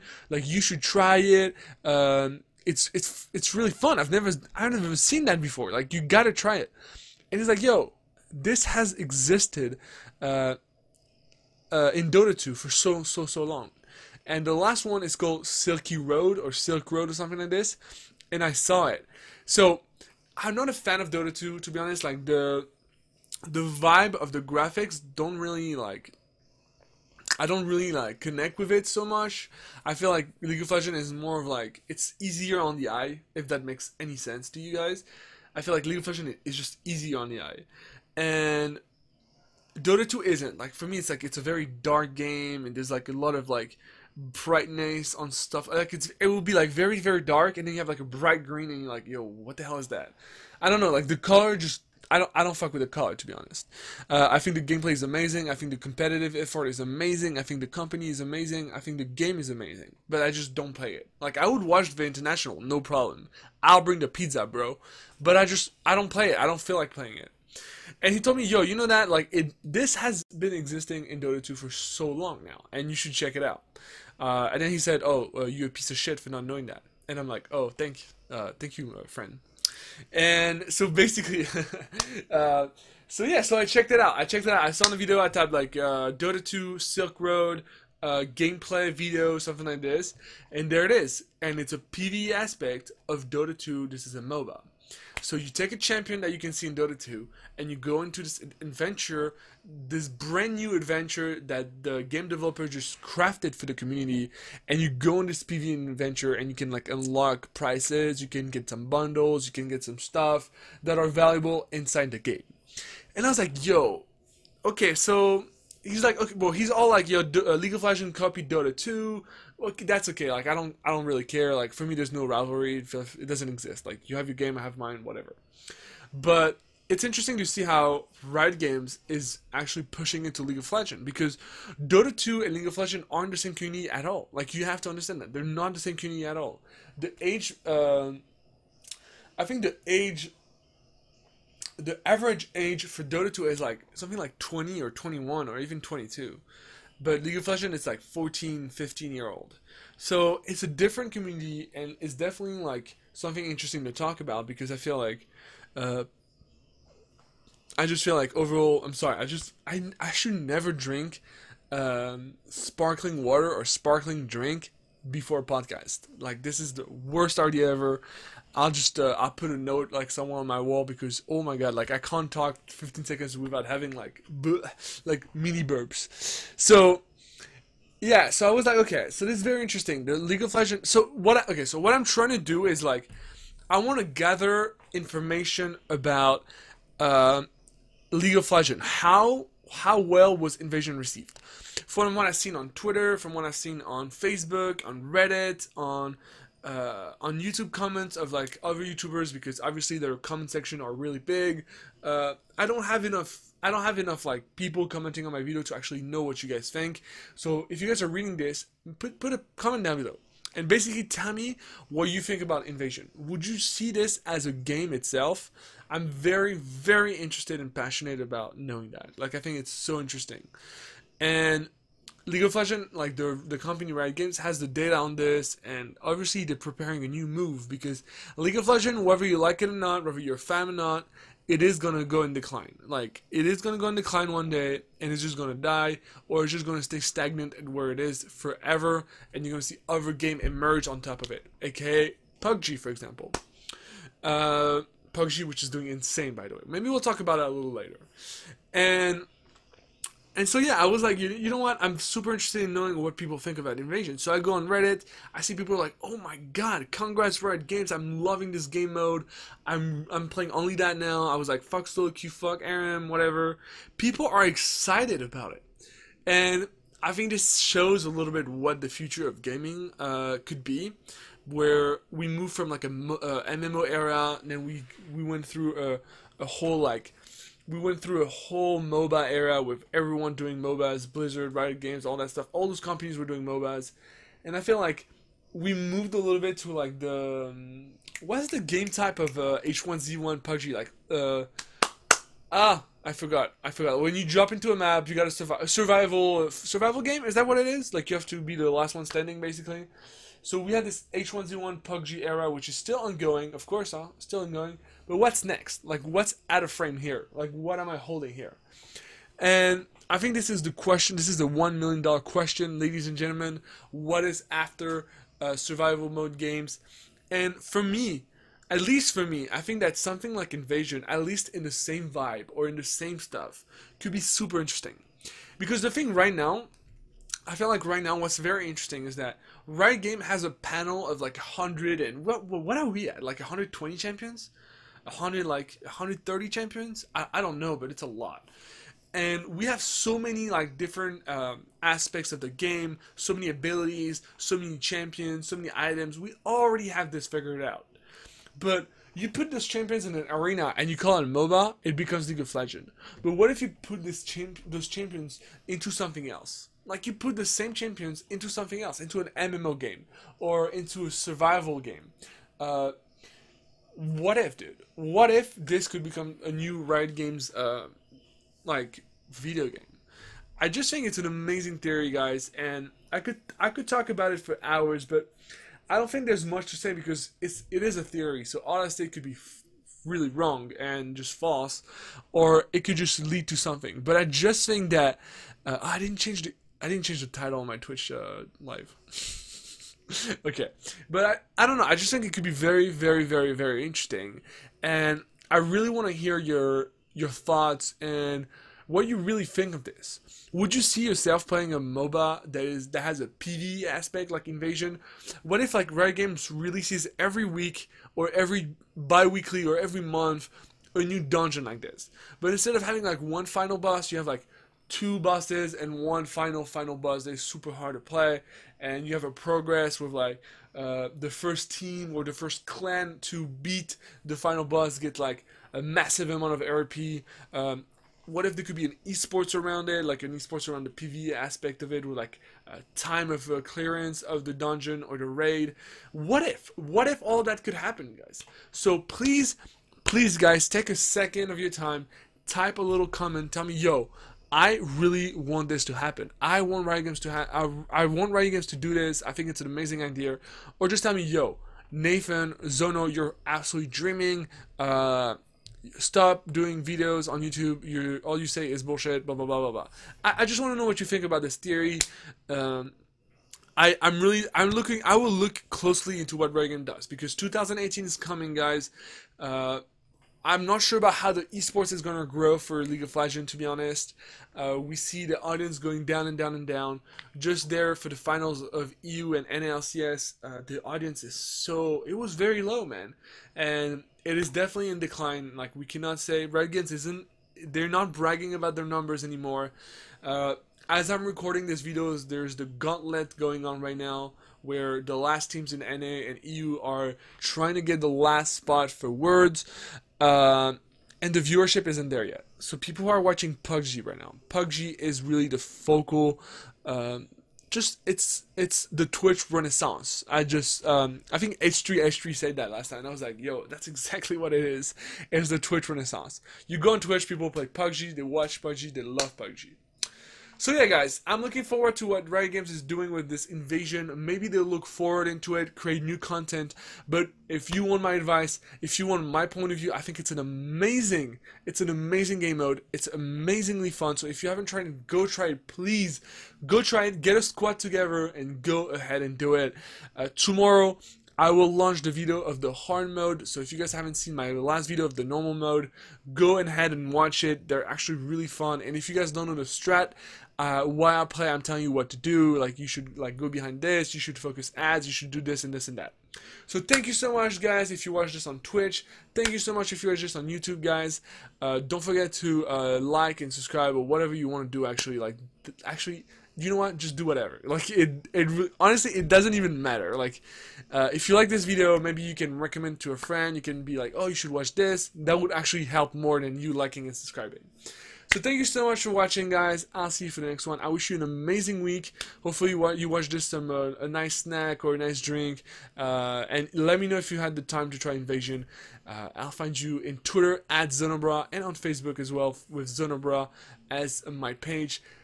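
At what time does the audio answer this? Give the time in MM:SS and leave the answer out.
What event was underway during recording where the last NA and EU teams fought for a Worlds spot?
08:12.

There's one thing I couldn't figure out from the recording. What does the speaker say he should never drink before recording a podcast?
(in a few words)
Sparkling water.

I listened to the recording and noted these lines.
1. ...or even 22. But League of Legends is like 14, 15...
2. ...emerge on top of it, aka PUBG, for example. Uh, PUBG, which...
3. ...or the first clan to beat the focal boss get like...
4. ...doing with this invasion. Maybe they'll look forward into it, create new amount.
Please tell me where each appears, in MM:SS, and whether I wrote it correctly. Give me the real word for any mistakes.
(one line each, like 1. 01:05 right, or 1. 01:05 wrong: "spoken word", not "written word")
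1. 02:25 right
2. 04:00 right
3. 07:02 wrong: "final", not "focal"
4. 08:42 wrong: "content", not "amount".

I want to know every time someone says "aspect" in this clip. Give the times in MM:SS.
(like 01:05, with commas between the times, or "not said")
01:32, 05:41, 06:43, 07:11.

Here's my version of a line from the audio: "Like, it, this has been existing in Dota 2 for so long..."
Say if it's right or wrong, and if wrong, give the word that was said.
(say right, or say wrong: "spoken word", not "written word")
right.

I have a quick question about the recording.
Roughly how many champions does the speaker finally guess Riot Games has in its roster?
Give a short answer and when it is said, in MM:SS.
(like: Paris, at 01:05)
130, at 05:35.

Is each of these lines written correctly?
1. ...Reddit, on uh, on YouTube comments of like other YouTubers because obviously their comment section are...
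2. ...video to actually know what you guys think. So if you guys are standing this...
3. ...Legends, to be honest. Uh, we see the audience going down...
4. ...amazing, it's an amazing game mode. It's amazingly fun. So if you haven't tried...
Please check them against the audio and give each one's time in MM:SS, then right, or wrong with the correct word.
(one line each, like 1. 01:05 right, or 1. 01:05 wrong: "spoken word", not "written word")
1. 03:15 right
2. 03:25 wrong: "reading", not "standing"
3. 07:53 right
4. 08:50 right.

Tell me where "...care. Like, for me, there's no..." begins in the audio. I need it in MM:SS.
02:01.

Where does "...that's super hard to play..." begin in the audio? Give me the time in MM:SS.
06:57.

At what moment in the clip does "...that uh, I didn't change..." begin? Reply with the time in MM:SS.
06:24.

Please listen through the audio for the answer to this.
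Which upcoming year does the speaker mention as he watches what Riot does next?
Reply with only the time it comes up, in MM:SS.
07:47.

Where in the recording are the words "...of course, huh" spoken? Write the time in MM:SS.
05:03.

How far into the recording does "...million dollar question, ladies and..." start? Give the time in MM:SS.
05:11.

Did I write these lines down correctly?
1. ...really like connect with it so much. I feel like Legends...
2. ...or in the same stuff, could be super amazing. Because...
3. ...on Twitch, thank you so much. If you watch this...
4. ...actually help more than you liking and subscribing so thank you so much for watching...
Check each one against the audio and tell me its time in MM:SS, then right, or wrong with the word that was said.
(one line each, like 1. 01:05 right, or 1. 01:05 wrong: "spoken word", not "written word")
1. 00:27 wrong: "League", not "Legends"
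2. 05:22 wrong: "interesting", not "amazing"
3. 09:18 right
4. 09:35 right.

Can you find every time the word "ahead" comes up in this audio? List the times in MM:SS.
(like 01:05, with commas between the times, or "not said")
08:58, 09:06.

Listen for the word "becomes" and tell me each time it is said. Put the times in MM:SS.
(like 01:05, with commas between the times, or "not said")
05:51, 06:06.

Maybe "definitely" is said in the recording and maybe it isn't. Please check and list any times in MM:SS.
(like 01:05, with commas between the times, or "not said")
02:32, 08:04.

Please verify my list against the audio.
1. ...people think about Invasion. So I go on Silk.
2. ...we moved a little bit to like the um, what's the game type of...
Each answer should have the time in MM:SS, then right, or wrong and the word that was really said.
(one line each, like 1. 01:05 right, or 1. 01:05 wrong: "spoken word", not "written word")
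1. 04:13 wrong: "Reddit", not "Silk"
2. 04:45 right.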